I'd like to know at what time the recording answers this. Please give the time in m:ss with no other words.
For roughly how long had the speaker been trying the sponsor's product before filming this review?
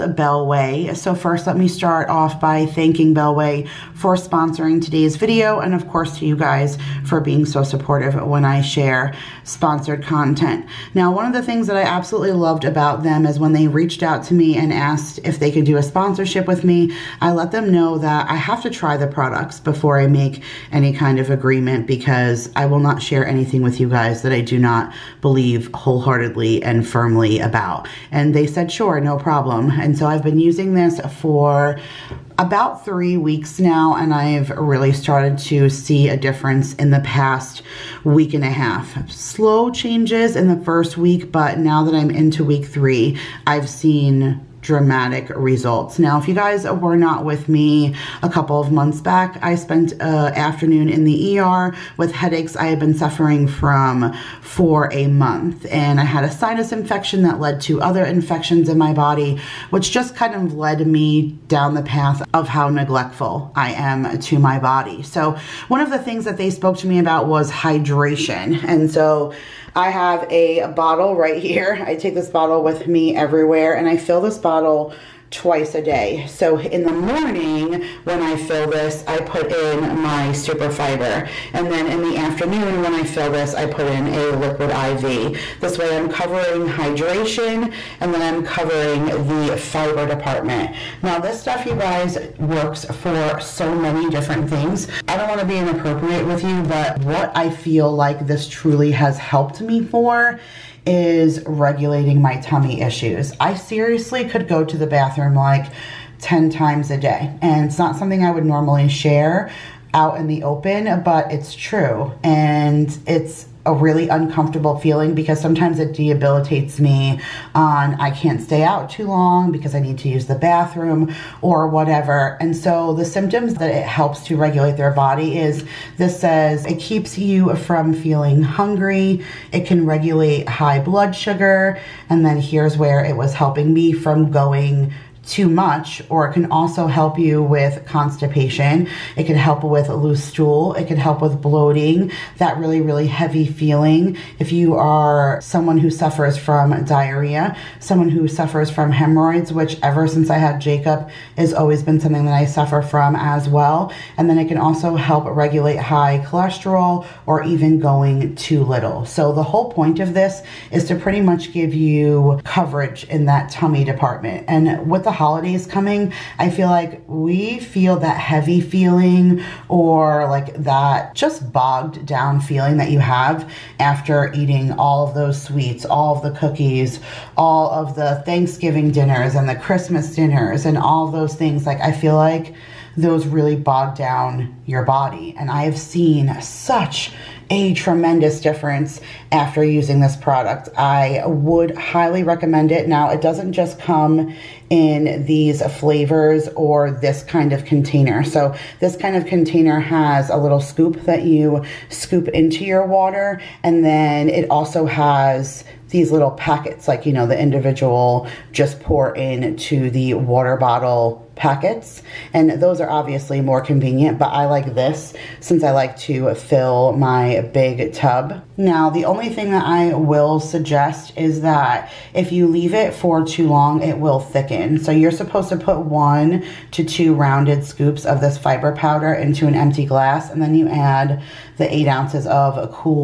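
0:32.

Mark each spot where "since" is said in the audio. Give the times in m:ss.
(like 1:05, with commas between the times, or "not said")
2:30, 3:35.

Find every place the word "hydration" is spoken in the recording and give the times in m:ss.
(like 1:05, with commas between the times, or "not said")
1:07, 1:26.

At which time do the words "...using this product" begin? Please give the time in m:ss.
3:09.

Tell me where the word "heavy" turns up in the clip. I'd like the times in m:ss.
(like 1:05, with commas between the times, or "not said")
2:23, 2:48.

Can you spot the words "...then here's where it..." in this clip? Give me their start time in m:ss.
2:12.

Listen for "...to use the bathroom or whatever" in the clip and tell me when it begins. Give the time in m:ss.
1:59.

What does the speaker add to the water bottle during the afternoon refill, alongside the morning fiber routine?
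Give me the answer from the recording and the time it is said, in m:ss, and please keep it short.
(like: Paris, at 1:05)
Liquid IV, at 1:24.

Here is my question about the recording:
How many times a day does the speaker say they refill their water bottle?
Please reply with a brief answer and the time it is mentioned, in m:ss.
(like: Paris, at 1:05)
Twice, at 1:15.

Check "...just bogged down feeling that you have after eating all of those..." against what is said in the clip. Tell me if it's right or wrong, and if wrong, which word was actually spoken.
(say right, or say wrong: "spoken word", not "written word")
right.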